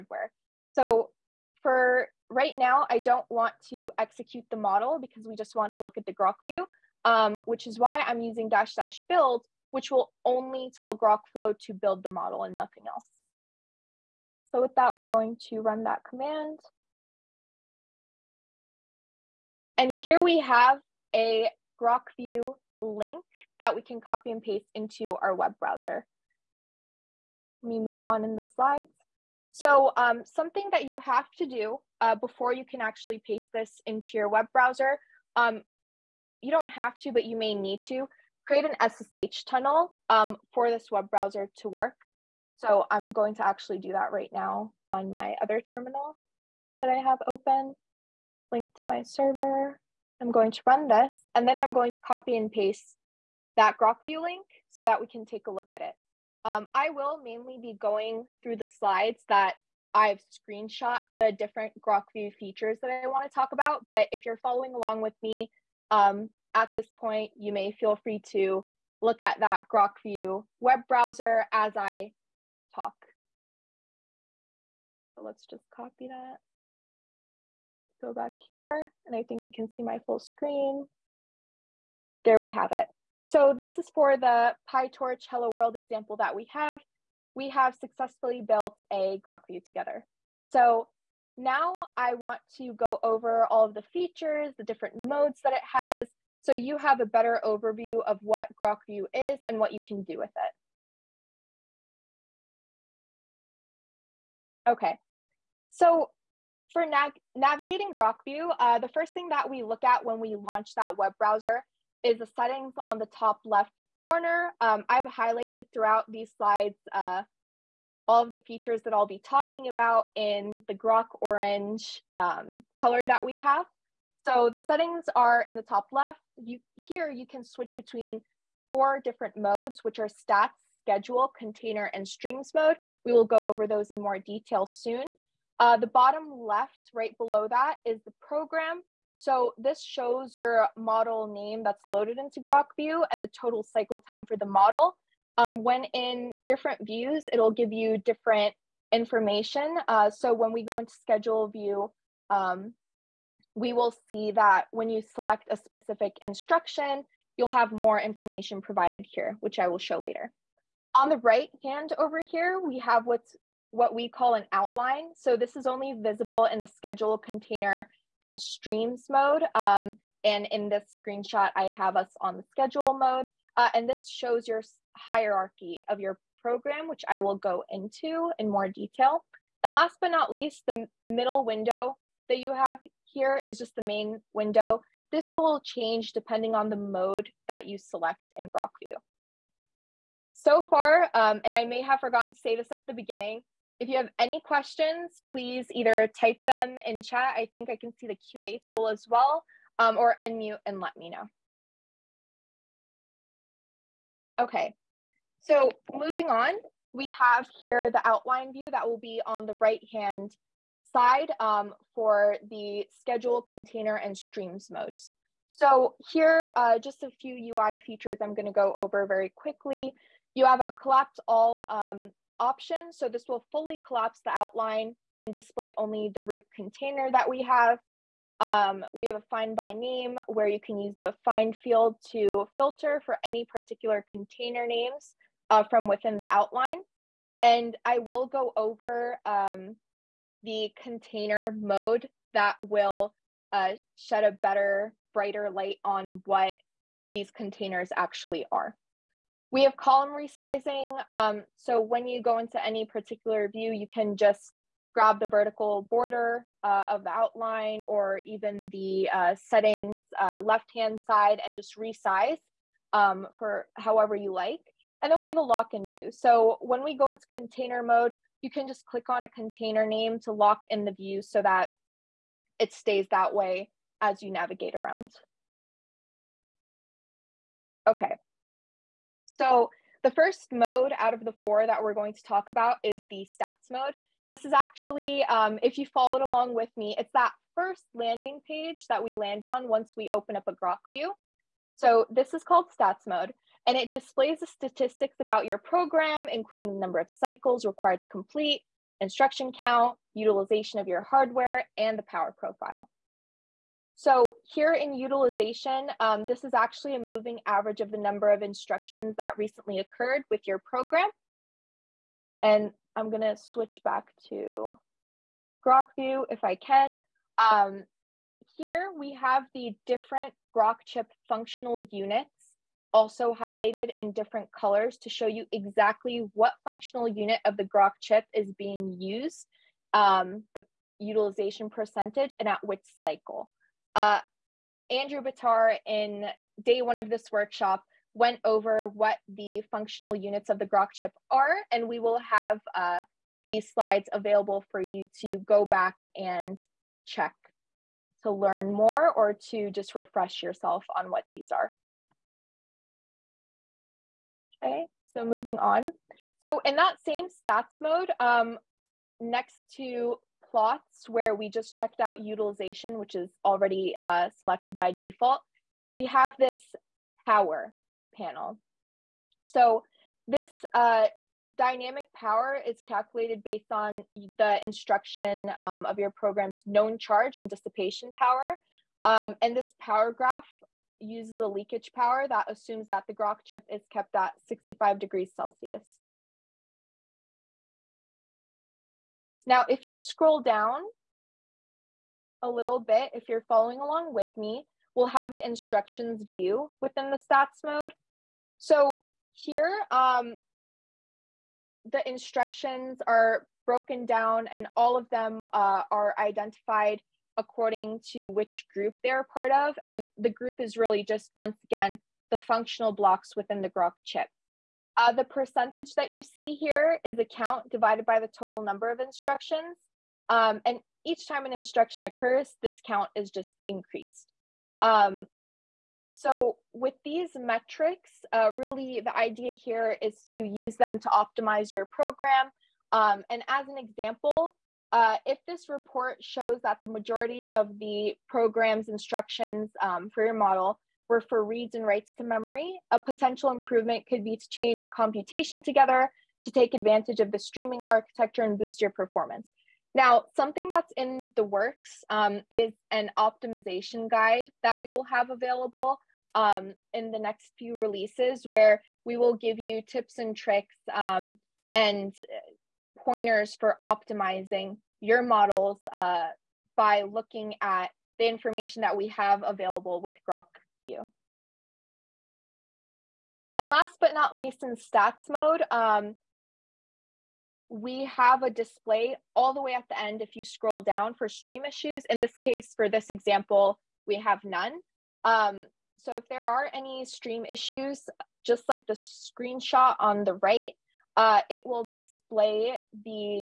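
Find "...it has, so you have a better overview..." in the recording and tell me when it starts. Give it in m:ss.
1:35.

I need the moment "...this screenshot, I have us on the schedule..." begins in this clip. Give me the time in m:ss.
2:50.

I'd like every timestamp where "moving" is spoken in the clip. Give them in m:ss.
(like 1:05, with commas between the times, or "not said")
3:25, 5:06, 5:55.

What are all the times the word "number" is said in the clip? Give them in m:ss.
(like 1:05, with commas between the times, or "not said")
4:56, 5:07, 6:58.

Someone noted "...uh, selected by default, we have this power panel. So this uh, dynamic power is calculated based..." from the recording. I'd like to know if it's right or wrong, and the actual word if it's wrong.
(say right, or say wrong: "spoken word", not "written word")
right.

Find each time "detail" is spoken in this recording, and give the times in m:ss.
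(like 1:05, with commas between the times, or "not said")
2:14, 2:58.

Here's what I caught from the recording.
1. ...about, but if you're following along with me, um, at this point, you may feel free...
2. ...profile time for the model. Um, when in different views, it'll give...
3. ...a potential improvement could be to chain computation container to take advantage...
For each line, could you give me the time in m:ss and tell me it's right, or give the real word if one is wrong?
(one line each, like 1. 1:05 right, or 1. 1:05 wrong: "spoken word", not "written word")
1. 1:03 right
2. 2:23 wrong: "cycle", not "profile"
3. 7:22 wrong: "together", not "container".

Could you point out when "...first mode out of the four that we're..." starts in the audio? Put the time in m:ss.
4:40.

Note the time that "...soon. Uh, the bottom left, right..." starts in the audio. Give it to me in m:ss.
2:14.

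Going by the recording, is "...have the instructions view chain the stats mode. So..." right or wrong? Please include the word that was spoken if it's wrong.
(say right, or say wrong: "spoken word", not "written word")
wrong: "within", not "chain".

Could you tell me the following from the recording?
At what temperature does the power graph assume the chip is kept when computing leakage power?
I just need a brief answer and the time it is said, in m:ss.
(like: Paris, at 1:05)
65 degrees Celsius, at 6:24.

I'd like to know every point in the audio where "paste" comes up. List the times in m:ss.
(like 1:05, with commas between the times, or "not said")
0:24, 0:33, 0:52.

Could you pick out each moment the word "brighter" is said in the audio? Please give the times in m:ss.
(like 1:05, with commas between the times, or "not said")
4:05.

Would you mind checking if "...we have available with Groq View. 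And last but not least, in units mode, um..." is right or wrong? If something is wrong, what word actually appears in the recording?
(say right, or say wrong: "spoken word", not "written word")
wrong: "stats", not "units".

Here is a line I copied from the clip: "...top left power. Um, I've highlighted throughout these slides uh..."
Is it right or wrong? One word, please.
wrong.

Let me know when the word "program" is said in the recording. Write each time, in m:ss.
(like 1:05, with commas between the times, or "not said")
2:18, 2:56, 4:55, 5:10, 6:16, 7:11, 7:18.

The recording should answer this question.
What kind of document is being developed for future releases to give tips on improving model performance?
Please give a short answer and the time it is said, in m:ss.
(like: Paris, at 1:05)
optimization guide, at 7:33.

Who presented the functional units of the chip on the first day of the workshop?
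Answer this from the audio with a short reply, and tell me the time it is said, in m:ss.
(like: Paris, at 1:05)
Andrew Batar, at 5:34.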